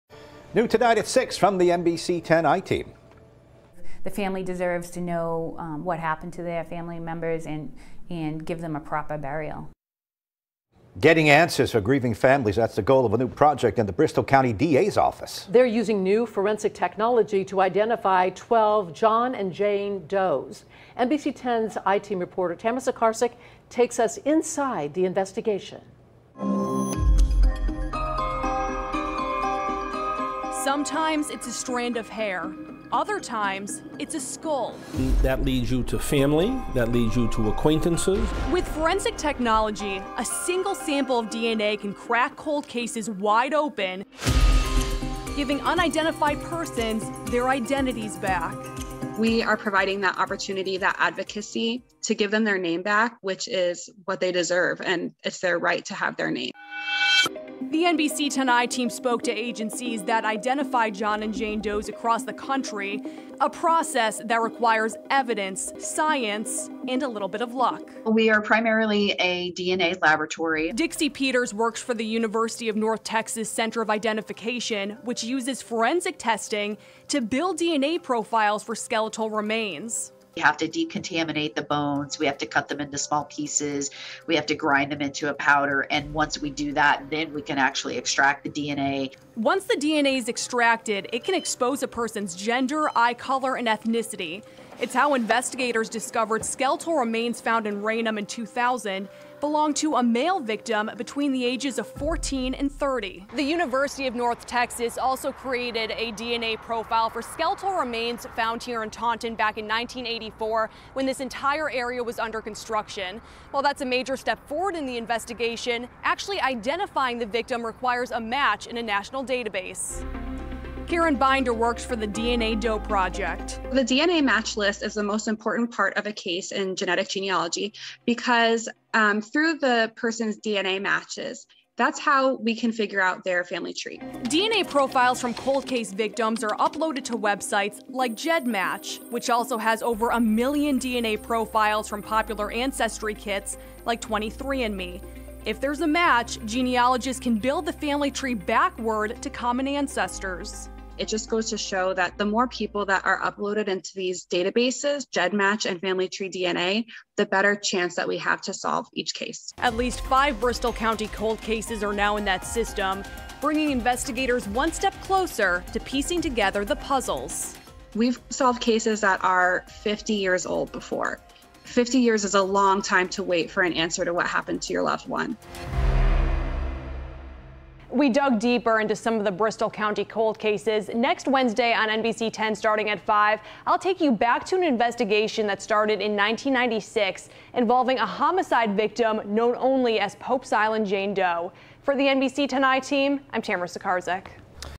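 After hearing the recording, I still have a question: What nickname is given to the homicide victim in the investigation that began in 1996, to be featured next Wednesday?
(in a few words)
Pope's Island Jane Doe.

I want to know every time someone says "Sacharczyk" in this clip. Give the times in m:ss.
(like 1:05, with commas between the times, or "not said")
0:22, 3:13.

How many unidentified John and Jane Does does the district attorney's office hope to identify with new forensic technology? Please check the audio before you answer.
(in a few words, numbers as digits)
12.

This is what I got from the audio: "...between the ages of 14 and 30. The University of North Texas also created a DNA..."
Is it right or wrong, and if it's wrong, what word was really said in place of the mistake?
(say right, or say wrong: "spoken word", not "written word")
right.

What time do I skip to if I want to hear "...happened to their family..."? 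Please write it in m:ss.
0:05.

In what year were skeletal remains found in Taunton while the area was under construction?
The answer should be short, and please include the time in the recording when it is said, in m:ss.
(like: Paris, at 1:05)
1984, at 1:49.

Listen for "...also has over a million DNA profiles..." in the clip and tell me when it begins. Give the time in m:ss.
2:19.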